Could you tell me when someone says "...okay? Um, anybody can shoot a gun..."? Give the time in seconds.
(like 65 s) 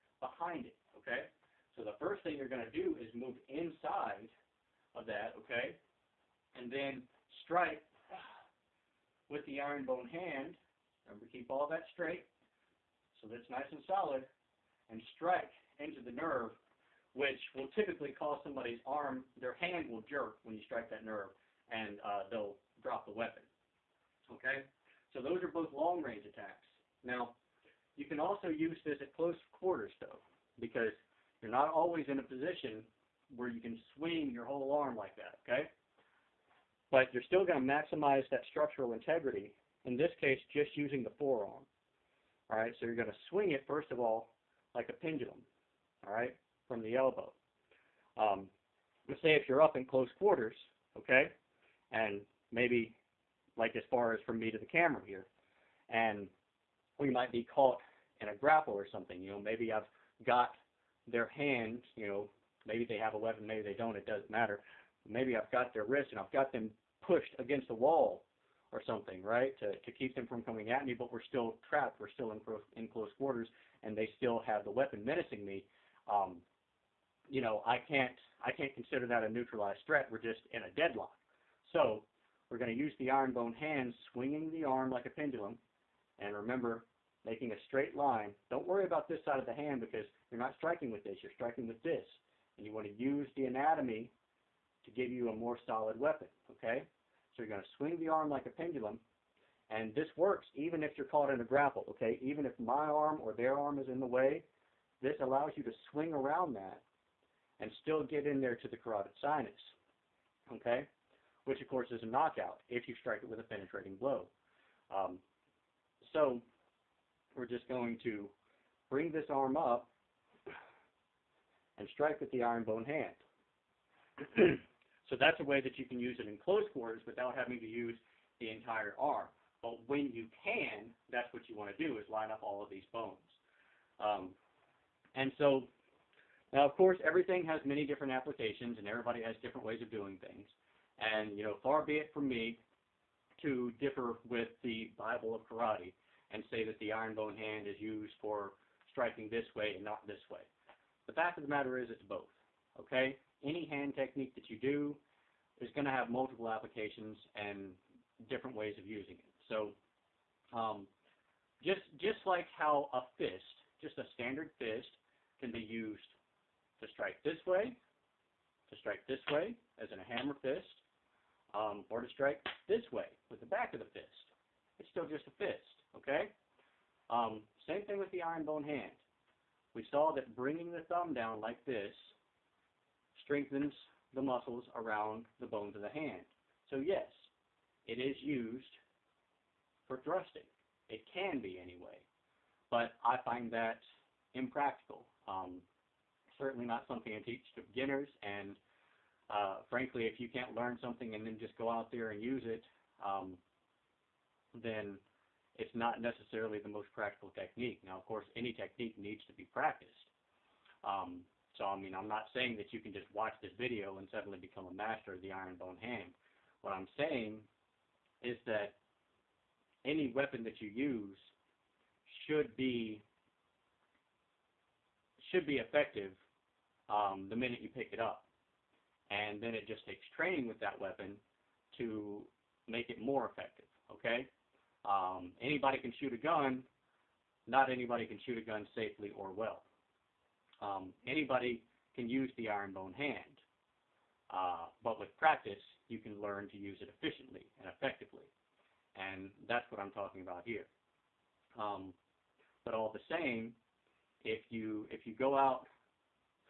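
233 s.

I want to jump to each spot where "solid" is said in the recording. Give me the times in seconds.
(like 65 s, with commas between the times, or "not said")
13 s, 95 s.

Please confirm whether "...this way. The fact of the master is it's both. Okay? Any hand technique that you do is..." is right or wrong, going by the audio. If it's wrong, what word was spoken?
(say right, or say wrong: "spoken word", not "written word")
wrong: "matter", not "master".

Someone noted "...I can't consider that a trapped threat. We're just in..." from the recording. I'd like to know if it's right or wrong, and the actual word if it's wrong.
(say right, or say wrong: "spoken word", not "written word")
wrong: "neutralized", not "trapped".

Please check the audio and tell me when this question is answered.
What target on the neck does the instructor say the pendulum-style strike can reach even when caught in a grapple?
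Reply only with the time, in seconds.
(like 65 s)
108 s.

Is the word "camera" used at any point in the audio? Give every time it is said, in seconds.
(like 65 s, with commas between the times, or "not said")
54 s.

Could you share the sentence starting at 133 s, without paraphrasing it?
Um, and so, now of course, everything has many different applications and everybody has different ways of doing things.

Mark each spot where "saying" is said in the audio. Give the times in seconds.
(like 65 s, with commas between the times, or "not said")
212 s, 216 s.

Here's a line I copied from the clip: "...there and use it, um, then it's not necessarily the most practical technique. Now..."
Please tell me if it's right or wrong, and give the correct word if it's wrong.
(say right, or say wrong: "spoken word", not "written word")
right.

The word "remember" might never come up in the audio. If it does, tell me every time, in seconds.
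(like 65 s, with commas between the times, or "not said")
11 s, 86 s.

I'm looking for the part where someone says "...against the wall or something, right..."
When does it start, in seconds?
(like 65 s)
67 s.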